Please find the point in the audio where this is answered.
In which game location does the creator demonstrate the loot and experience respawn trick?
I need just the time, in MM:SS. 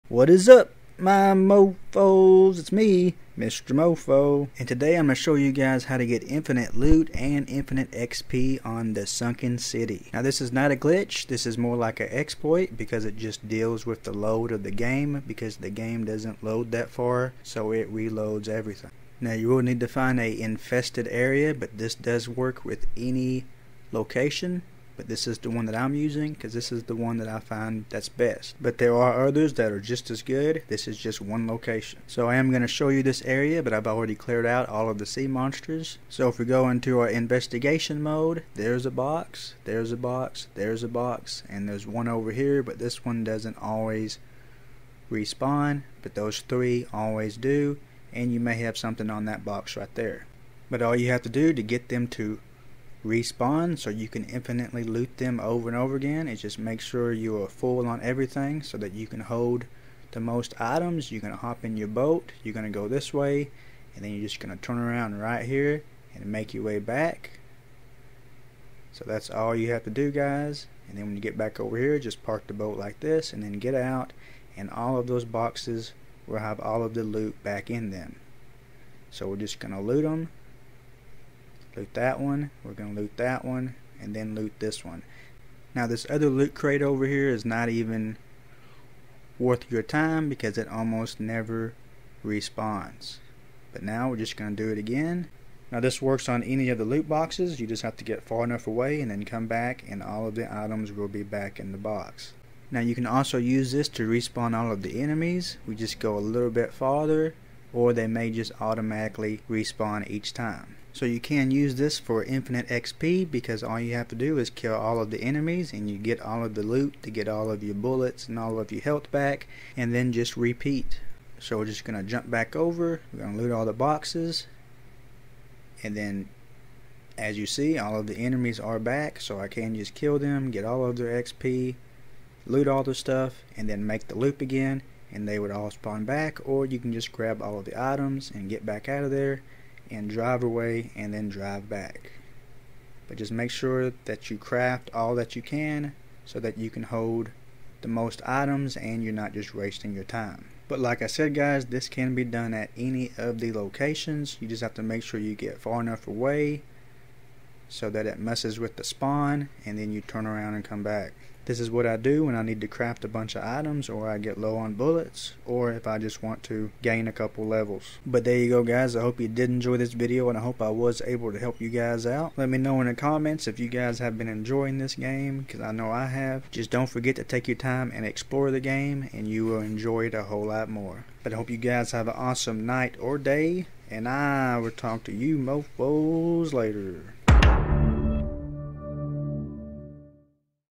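00:09.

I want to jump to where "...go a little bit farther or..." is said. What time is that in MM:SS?
01:45.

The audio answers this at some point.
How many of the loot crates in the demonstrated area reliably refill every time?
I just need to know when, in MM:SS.
00:46.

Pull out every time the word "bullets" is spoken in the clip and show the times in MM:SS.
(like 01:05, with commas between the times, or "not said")
01:57, 02:44.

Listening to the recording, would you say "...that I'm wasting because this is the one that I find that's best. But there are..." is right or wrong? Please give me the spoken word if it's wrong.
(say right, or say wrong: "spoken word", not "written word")
wrong: "using", not "wasting".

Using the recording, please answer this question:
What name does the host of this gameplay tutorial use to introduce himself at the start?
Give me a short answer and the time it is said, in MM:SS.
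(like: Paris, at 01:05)
Mr. Mofo, at 00:03.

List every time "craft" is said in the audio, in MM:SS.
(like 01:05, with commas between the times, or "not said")
02:24, 02:42.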